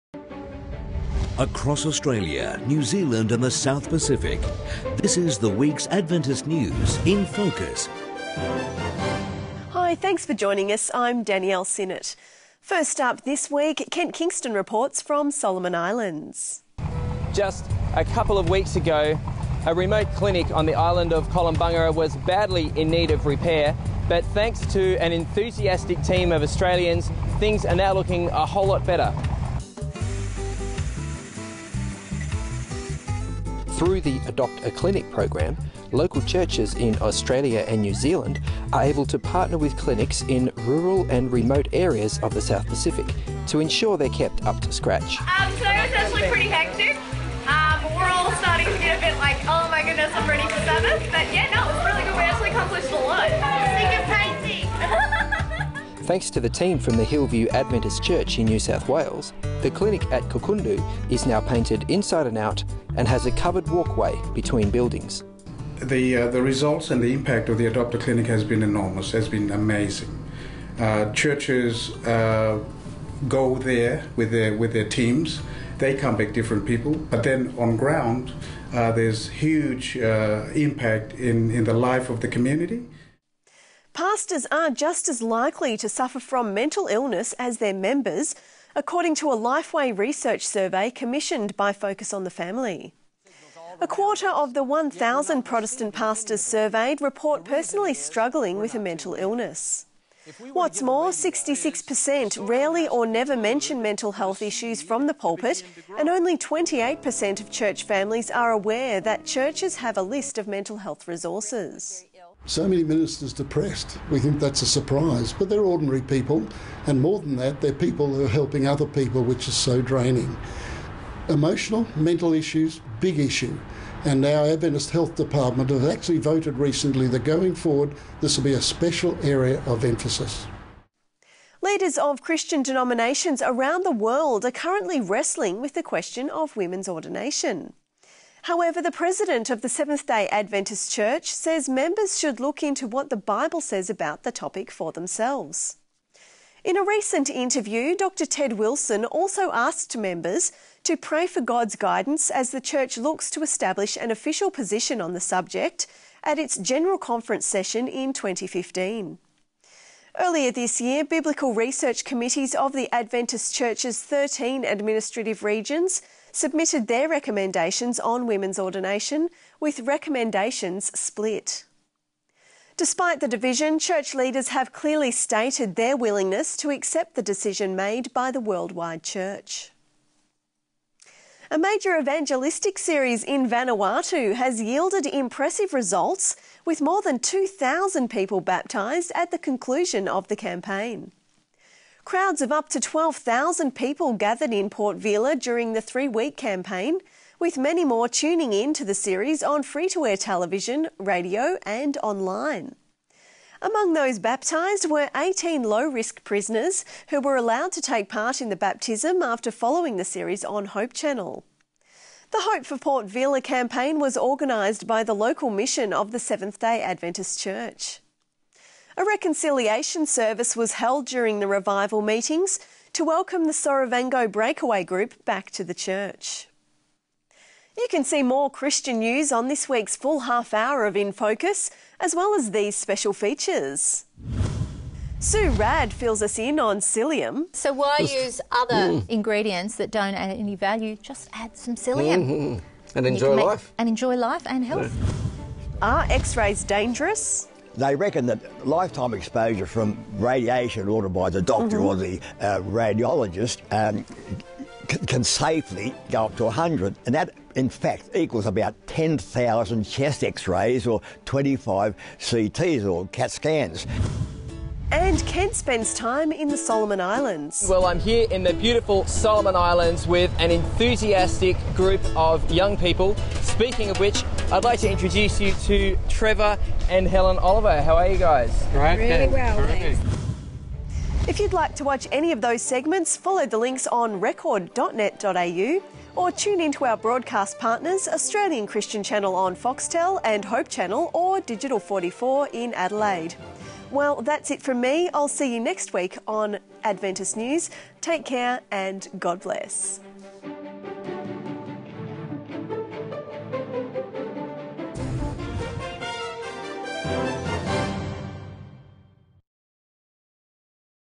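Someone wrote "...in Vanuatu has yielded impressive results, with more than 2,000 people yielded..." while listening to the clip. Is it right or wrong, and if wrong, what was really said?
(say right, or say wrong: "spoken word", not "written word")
wrong: "baptised", not "yielded".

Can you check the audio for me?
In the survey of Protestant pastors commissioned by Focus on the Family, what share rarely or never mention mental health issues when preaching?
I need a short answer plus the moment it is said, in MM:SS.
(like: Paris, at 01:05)
66%, at 01:41.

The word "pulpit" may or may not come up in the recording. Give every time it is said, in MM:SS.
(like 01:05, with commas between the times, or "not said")
01:45.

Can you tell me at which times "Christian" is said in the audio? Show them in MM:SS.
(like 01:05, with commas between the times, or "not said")
02:12, 03:48, 04:48.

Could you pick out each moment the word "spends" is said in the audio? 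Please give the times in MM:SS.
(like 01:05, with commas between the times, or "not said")
04:25.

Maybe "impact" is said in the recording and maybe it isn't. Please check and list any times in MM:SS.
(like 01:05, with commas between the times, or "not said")
01:07, 01:20.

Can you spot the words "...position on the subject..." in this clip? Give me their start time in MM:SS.
02:34.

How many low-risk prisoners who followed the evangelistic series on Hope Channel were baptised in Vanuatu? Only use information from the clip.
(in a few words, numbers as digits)
18.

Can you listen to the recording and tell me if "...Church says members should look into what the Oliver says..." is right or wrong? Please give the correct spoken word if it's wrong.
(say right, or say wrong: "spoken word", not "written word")
wrong: "Bible", not "Oliver".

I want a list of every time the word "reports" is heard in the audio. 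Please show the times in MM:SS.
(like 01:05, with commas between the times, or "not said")
00:14, 01:37.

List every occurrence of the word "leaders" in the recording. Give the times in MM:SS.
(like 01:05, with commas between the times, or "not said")
02:11, 02:54.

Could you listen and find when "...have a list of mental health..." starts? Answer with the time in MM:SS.
01:49.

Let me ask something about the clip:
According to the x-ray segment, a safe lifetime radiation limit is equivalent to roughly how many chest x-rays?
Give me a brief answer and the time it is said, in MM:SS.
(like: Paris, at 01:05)
10,000, at 04:18.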